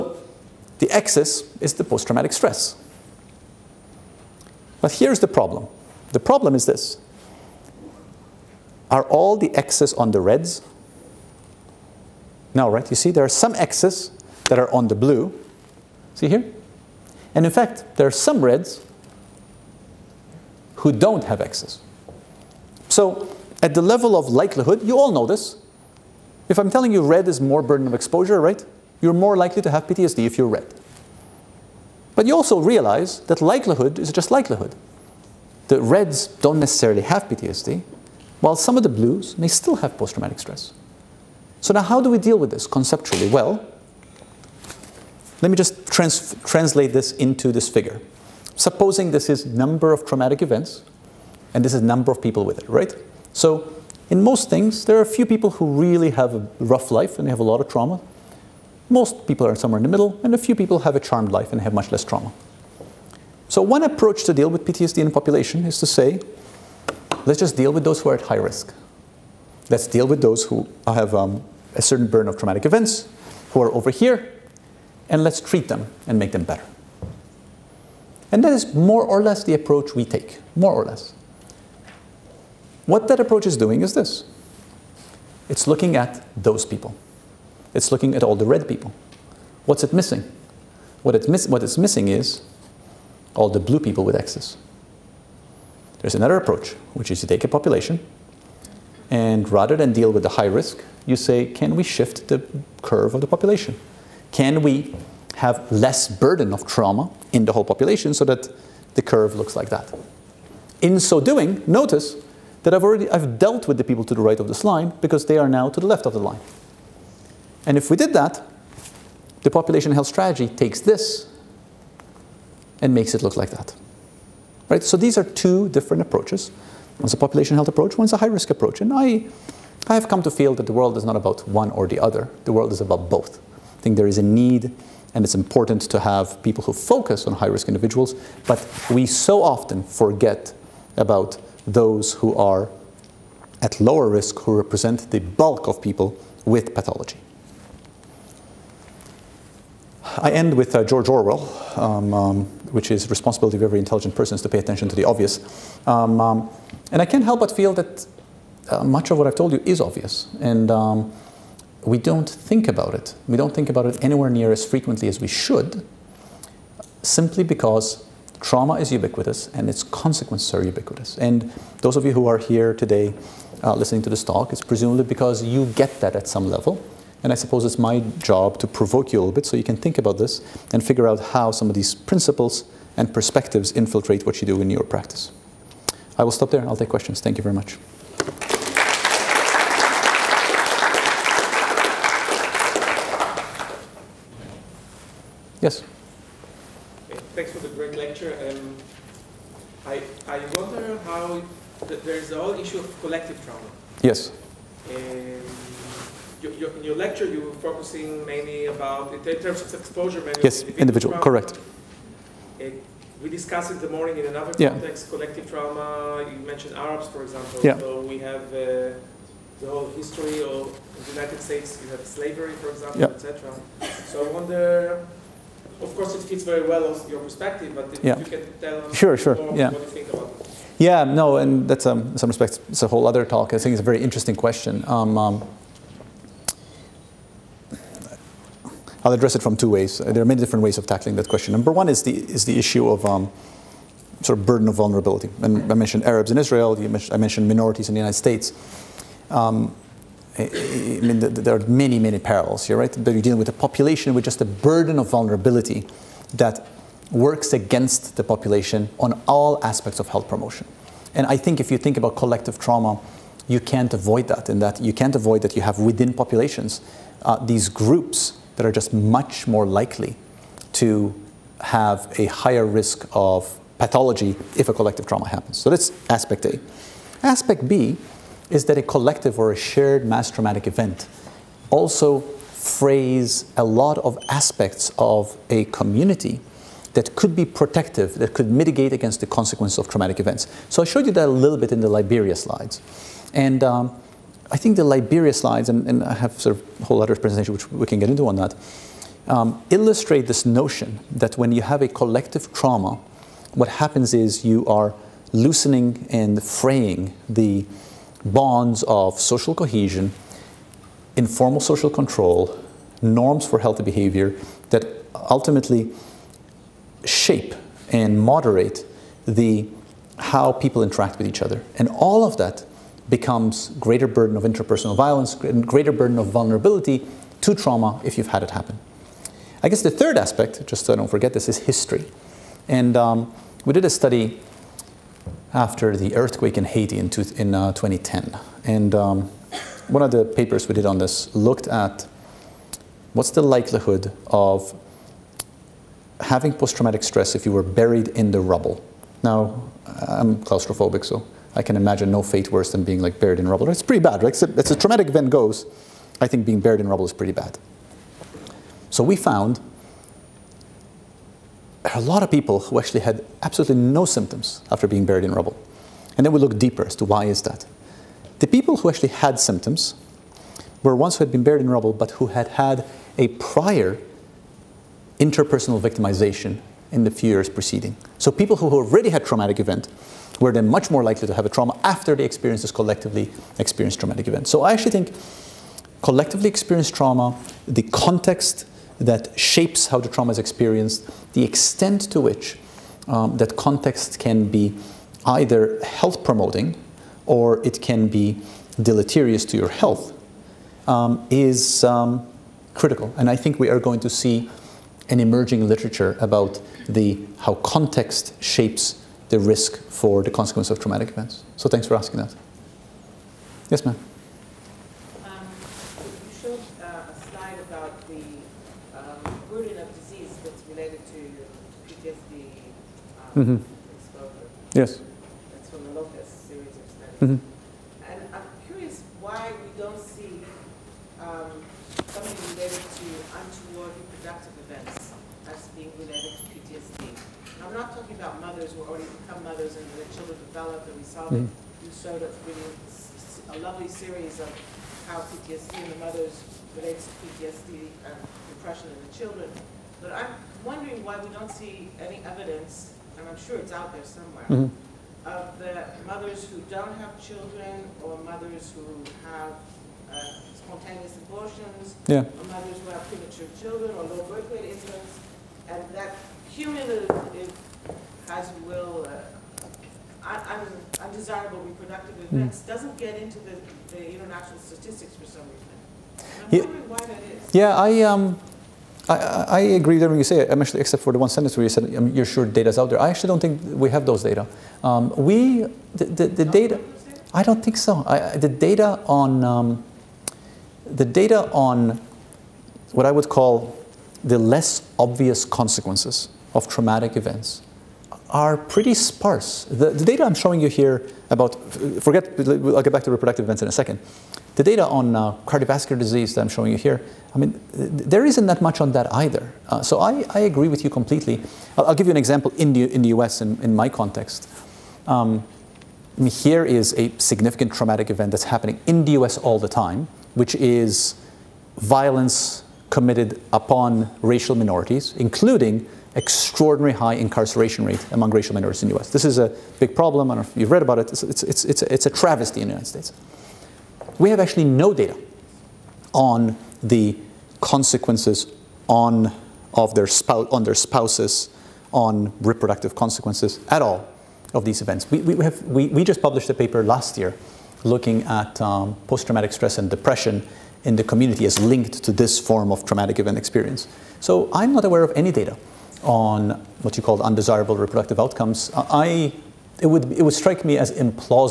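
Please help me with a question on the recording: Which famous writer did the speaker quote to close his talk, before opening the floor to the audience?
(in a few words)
George Orwell.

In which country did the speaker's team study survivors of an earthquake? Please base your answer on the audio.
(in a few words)
Haiti.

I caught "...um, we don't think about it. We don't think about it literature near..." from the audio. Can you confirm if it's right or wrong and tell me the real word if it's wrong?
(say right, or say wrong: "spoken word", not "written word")
wrong: "anywhere", not "literature".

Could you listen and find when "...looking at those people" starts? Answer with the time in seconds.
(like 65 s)
85 s.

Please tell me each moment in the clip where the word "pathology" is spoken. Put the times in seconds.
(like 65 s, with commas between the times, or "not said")
146 s, 273 s.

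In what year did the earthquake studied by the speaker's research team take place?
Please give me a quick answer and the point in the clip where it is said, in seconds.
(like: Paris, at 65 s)
2010, at 337 s.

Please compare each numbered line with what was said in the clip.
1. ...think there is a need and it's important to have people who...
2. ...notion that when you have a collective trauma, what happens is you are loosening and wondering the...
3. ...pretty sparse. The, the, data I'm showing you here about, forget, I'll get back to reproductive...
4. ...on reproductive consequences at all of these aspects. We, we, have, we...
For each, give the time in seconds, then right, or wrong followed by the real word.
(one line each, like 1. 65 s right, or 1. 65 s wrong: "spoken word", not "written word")
1. 133 s right
2. 300 s wrong: "fraying", not "wondering"
3. 498 s right
4. 541 s wrong: "events", not "aspects".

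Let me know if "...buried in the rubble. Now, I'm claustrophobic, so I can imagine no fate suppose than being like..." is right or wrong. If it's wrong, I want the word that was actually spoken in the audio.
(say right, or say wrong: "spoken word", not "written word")
wrong: "worse", not "suppose".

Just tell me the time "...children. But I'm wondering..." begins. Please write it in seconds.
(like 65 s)
449 s.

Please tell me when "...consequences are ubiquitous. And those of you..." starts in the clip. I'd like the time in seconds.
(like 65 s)
169 s.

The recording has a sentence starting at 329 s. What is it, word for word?
I guess the third aspect, just so I don't forget this, is history.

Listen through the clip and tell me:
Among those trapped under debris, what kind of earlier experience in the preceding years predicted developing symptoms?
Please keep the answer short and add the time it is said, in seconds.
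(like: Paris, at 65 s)
Interpersonal victimization, at 375 s.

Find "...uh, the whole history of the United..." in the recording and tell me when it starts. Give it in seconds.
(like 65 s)
218 s.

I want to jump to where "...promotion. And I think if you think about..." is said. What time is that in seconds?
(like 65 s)
260 s.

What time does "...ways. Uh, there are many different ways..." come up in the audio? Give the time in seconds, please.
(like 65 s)
239 s.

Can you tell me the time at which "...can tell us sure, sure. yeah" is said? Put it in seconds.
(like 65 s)
228 s.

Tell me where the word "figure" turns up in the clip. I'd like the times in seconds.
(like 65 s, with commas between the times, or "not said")
47 s, 180 s.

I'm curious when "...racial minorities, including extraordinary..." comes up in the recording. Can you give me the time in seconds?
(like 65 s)
524 s.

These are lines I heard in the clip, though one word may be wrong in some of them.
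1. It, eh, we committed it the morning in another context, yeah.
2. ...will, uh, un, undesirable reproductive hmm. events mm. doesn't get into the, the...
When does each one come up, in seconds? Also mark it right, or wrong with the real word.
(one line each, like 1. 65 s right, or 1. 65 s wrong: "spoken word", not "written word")
1. 212 s wrong: "discussed", not "committed"
2. 468 s right.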